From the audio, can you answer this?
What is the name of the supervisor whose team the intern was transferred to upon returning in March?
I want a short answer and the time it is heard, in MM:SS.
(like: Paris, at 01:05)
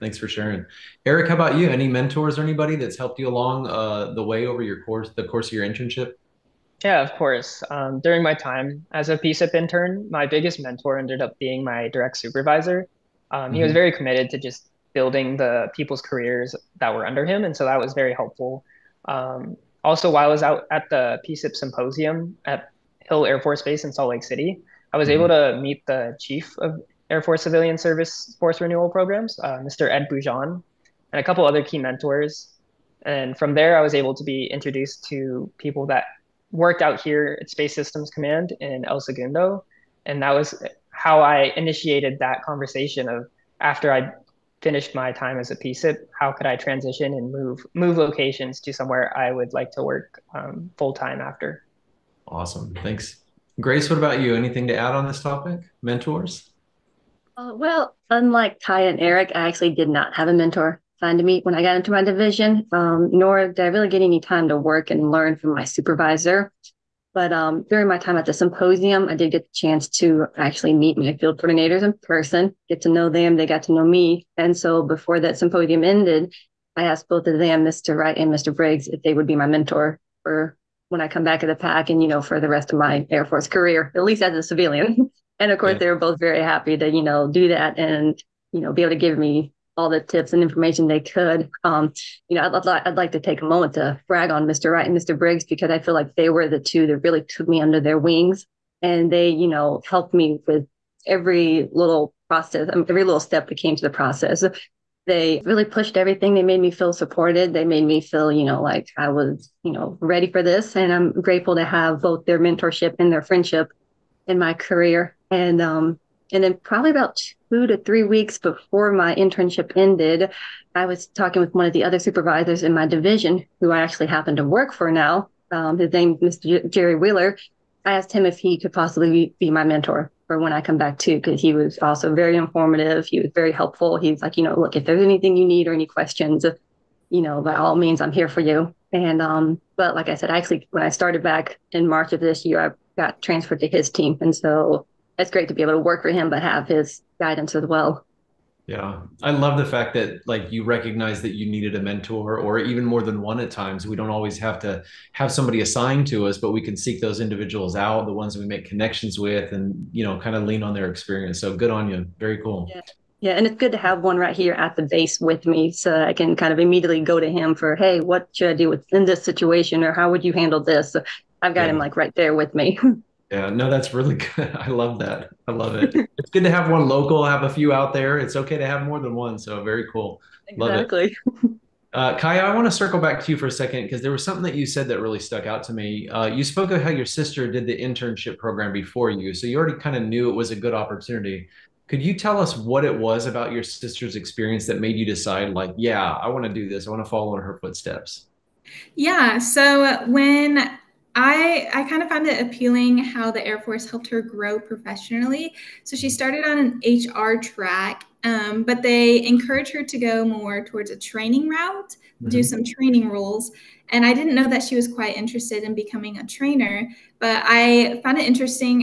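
Jerry Wheeler, at 02:06.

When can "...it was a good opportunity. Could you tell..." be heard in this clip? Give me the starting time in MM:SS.
03:10.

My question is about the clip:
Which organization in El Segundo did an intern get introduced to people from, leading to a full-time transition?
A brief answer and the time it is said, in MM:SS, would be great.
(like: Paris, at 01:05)
Space Systems Command, at 00:37.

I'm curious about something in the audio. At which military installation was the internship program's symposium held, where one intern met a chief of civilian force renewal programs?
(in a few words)
Hill Air Force Base.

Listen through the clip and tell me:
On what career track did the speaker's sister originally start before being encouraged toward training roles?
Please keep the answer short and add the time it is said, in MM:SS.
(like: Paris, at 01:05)
HR, at 03:26.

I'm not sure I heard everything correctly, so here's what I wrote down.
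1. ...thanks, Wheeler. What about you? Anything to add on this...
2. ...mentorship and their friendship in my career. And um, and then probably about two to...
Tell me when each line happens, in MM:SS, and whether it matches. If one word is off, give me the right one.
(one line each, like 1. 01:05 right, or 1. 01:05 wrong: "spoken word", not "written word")
1. 00:52 wrong: "Grace", not "Wheeler"
2. 01:52 right.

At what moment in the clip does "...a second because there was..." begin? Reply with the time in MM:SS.
03:03.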